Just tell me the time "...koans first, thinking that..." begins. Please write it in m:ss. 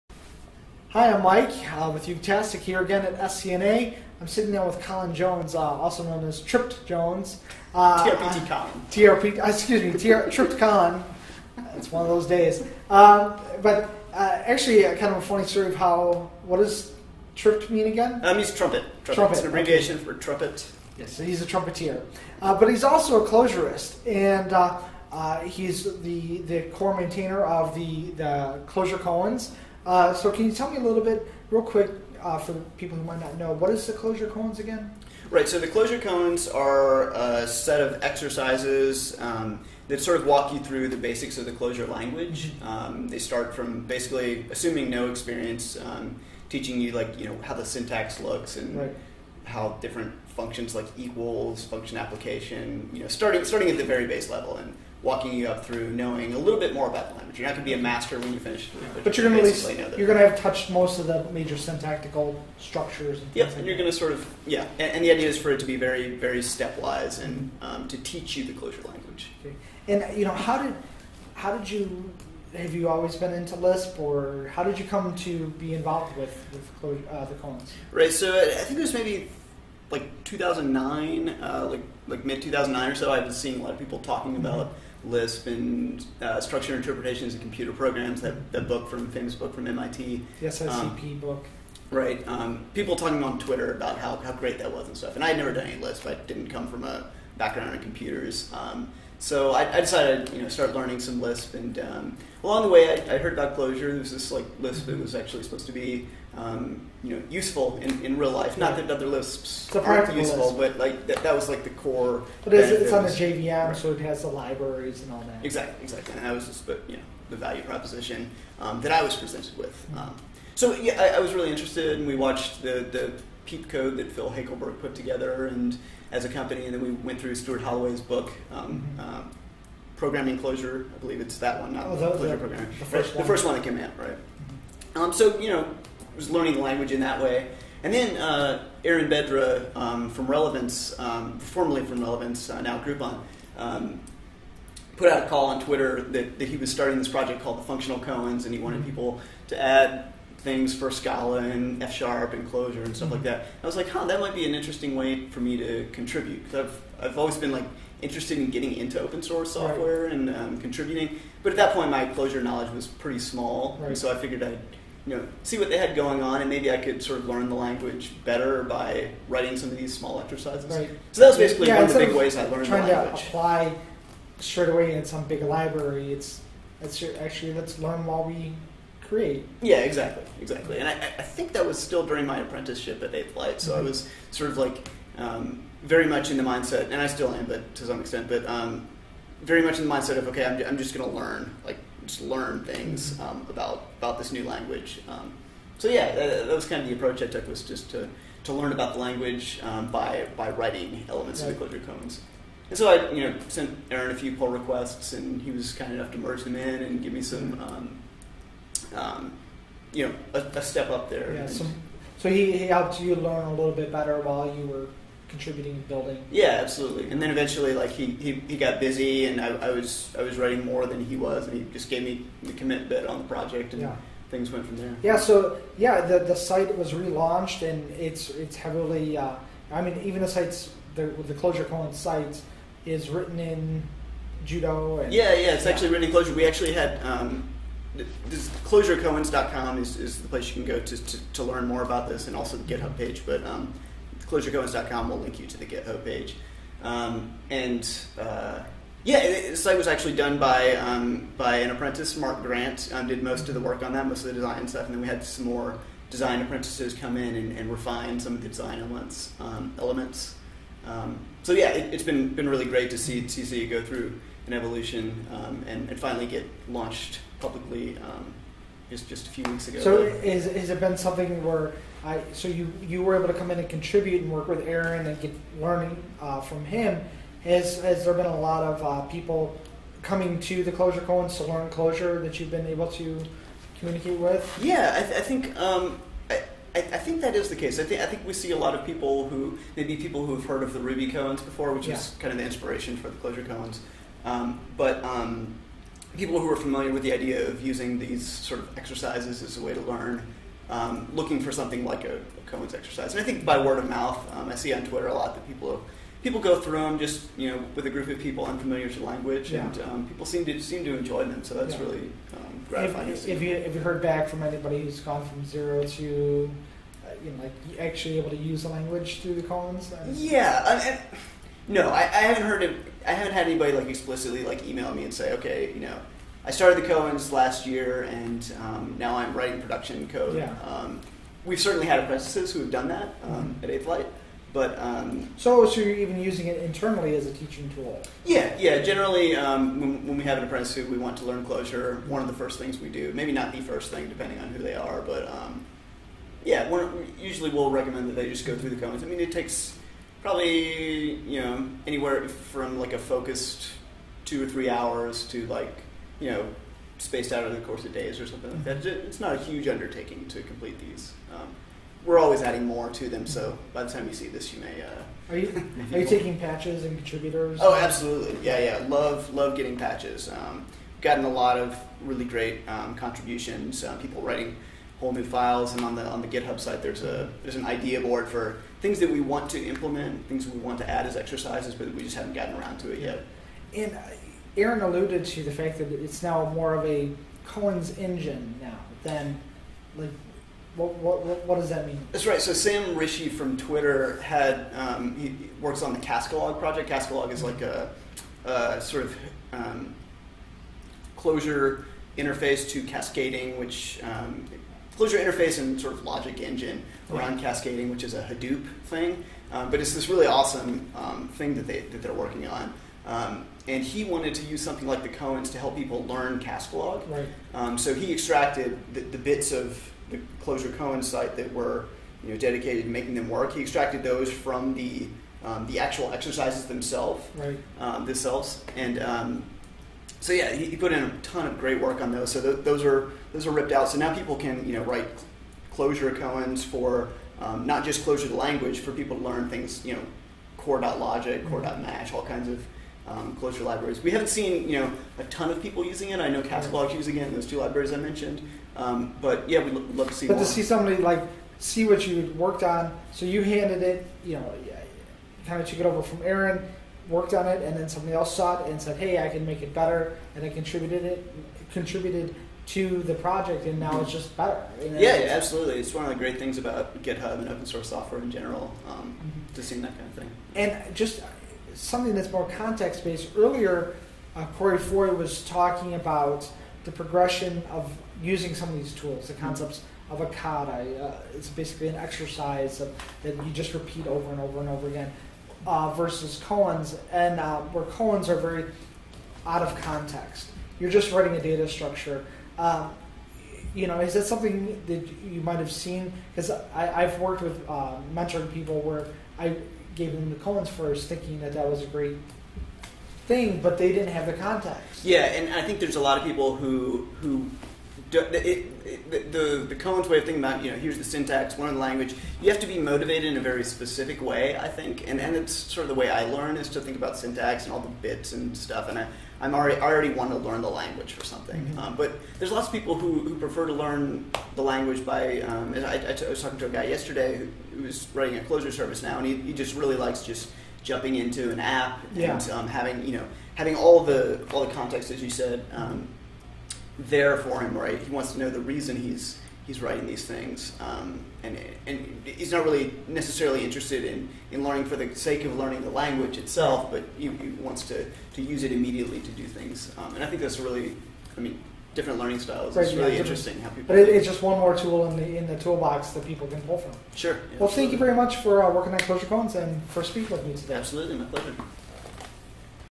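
8:20.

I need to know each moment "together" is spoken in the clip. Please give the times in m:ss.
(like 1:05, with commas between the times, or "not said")
2:04.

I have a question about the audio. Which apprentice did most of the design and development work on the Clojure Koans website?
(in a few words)
Mark Grant.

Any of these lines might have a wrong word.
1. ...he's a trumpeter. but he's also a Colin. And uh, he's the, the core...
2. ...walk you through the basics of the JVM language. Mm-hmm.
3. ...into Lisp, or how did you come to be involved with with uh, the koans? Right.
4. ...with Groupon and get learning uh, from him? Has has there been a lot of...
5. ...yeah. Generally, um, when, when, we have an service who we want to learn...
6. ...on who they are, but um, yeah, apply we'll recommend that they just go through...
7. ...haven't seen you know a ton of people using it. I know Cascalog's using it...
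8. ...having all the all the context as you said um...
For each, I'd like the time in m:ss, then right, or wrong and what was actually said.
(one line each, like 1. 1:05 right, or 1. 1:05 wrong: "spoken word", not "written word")
1. 0:21 wrong: "Clojurist", not "Colin"
2. 0:40 wrong: "Clojure", not "JVM"
3. 1:13 right
4. 4:34 wrong: "Aaron", not "Groupon"
5. 5:38 wrong: "apprentice", not "service"
6. 5:44 wrong: "usually", not "apply"
7. 7:24 right
8. 8:53 right.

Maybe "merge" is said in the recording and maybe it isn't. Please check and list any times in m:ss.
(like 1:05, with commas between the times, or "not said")
3:26.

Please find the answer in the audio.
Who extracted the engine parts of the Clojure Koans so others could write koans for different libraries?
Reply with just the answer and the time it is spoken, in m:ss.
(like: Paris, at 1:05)
Sam Ritchie, at 6:32.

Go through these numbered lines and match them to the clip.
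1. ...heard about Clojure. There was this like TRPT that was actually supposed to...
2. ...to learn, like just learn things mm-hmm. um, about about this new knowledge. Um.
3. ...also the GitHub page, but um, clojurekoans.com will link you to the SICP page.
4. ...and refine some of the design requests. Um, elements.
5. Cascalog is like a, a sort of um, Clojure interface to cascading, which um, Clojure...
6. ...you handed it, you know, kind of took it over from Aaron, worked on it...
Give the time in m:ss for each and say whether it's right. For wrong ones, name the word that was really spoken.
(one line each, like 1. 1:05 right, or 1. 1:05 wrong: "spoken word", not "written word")
1. 1:43 wrong: "Lisp", not "TRPT"
2. 3:11 wrong: "language", not "knowledge"
3. 4:02 wrong: "GitHub", not "SICP"
4. 4:17 wrong: "elements", not "requests"
5. 6:36 right
6. 7:33 right.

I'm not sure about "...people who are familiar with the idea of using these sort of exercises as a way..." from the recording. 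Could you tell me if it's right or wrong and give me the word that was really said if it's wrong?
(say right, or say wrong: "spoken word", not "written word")
right.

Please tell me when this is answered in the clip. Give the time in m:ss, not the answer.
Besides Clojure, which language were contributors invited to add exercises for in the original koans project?
2:30.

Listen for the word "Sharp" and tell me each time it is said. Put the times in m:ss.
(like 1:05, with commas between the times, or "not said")
2:31.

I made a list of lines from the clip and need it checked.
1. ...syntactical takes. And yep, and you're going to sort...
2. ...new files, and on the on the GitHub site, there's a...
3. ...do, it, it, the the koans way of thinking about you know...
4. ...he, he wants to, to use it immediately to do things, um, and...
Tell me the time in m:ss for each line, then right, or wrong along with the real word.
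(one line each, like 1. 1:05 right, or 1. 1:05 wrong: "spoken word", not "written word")
1. 1:01 wrong: "structures", not "takes"
2. 6:15 right
3. 8:28 right
4. 9:07 right.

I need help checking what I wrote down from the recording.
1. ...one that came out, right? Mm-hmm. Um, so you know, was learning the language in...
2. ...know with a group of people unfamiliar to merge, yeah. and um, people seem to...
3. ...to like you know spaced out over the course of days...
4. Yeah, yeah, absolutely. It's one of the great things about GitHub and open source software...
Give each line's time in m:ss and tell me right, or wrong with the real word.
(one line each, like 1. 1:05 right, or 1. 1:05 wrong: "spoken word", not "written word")
1. 2:13 right
2. 5:07 wrong: "language", not "merge"
3. 5:55 right
4. 7:44 right.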